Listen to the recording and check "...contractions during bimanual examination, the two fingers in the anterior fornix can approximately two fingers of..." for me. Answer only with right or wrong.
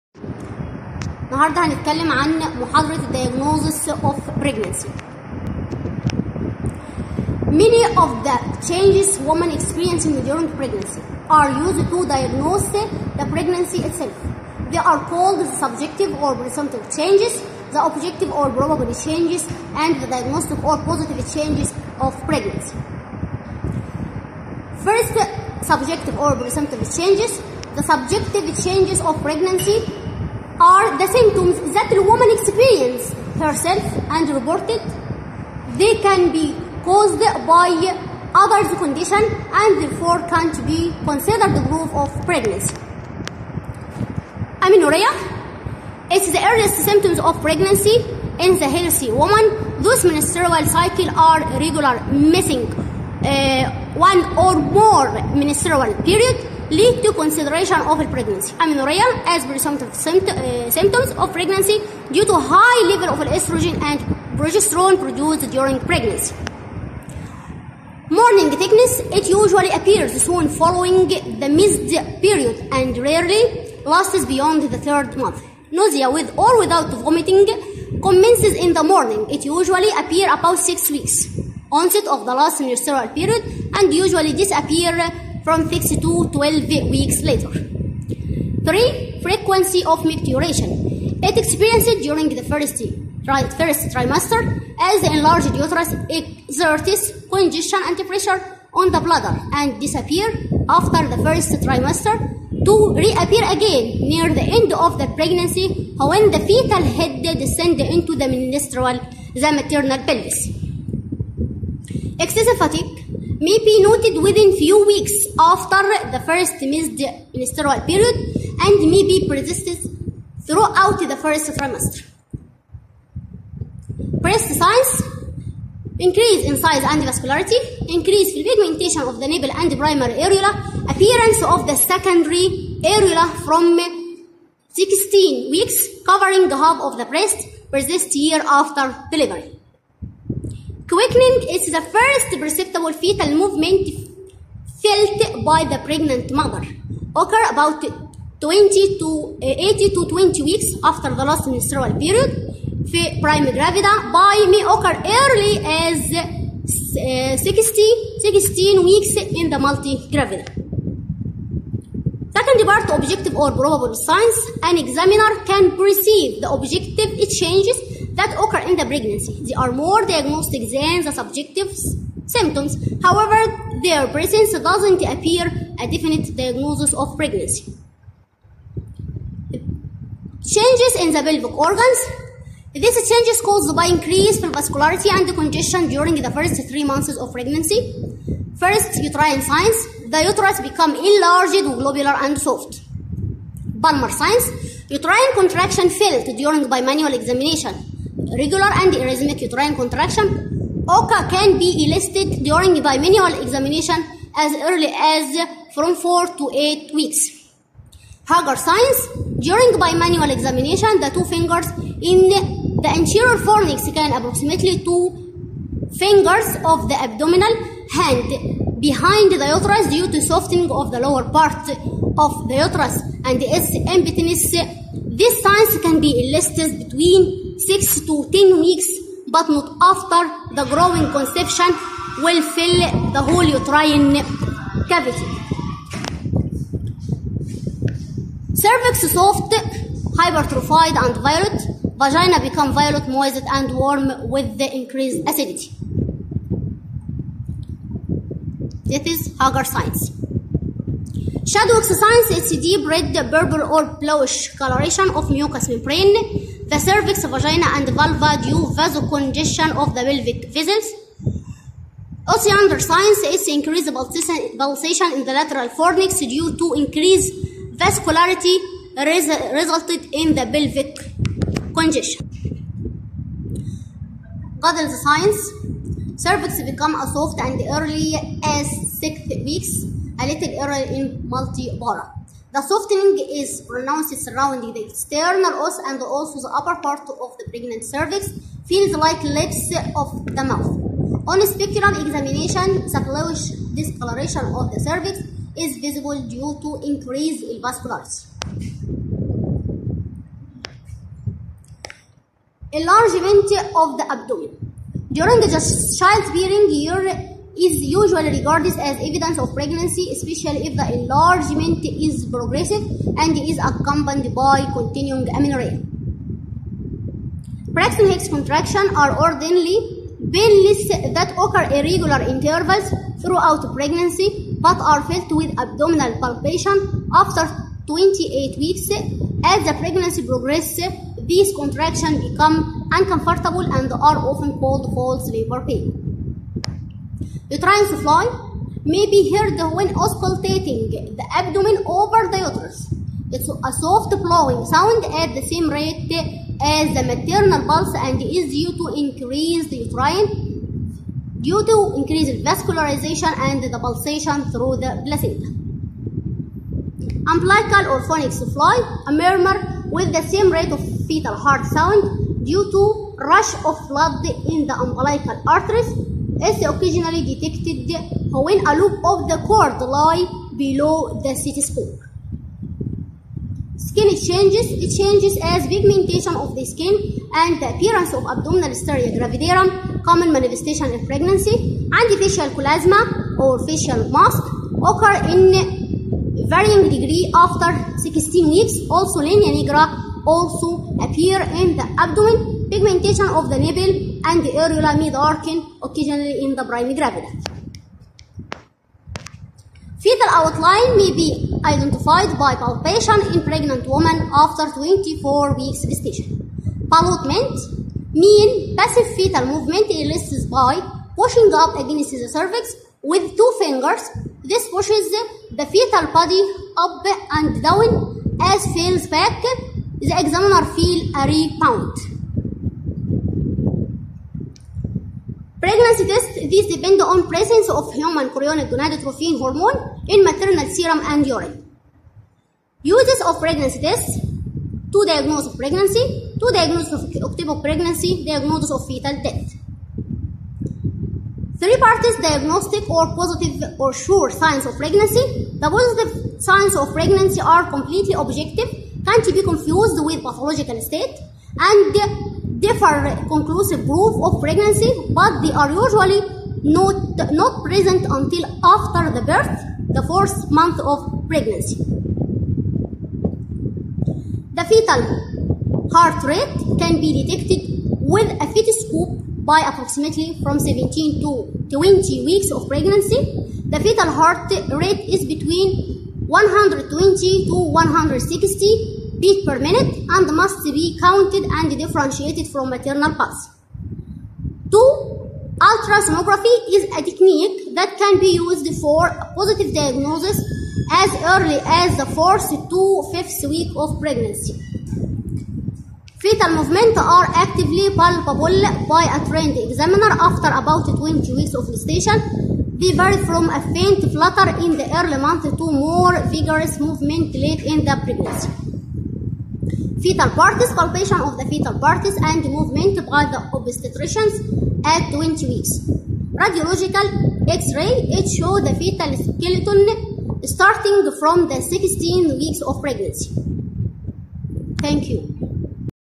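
wrong.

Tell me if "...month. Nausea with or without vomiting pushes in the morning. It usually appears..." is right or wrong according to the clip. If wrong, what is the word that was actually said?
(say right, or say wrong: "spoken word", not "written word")
wrong: "commences", not "pushes".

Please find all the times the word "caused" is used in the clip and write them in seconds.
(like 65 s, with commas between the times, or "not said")
36 s, 183 s.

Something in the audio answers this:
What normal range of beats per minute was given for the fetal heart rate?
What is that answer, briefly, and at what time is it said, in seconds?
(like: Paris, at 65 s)
120 to 160, at 476 s.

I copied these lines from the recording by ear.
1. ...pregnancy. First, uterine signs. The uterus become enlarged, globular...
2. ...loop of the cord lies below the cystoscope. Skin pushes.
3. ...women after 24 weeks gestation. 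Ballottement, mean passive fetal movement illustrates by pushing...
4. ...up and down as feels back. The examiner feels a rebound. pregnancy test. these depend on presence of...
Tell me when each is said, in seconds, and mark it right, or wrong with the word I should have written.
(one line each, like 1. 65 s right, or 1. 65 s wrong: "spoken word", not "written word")
1. 187 s right
2. 368 s wrong: "changes", not "pushes"
3. 403 s right
4. 416 s right.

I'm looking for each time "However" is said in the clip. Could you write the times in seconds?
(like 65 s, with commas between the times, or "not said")
173 s.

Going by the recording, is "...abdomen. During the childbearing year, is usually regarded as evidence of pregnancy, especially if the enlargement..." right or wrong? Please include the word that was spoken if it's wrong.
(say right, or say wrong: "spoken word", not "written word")
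right.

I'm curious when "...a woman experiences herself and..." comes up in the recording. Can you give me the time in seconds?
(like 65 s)
31 s.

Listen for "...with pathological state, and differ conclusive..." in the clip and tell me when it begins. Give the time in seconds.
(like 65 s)
450 s.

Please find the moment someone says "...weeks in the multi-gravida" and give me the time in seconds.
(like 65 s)
158 s.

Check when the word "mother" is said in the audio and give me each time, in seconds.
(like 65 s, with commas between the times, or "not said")
146 s.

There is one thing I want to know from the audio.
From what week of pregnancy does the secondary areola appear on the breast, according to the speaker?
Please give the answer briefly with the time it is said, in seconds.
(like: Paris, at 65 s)
16 weeks, at 133 s.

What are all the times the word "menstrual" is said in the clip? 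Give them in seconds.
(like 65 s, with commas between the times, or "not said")
50 s, 55 s, 82 s, 108 s, 117 s, 151 s.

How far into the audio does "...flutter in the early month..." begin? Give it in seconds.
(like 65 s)
504 s.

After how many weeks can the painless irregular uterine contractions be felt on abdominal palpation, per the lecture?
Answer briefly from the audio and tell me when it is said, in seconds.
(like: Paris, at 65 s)
28 weeks, at 327 s.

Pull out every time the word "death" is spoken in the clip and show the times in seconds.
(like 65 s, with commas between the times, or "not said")
439 s.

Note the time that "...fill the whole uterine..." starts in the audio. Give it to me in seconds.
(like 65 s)
232 s.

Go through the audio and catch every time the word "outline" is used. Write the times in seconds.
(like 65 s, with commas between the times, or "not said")
400 s.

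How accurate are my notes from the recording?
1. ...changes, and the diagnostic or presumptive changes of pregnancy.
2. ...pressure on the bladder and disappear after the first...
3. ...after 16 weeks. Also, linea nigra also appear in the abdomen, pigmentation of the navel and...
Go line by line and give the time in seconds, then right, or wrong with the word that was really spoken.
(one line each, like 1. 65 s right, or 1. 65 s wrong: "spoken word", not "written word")
1. 19 s wrong: "positive", not "presumptive"
2. 98 s right
3. 387 s right.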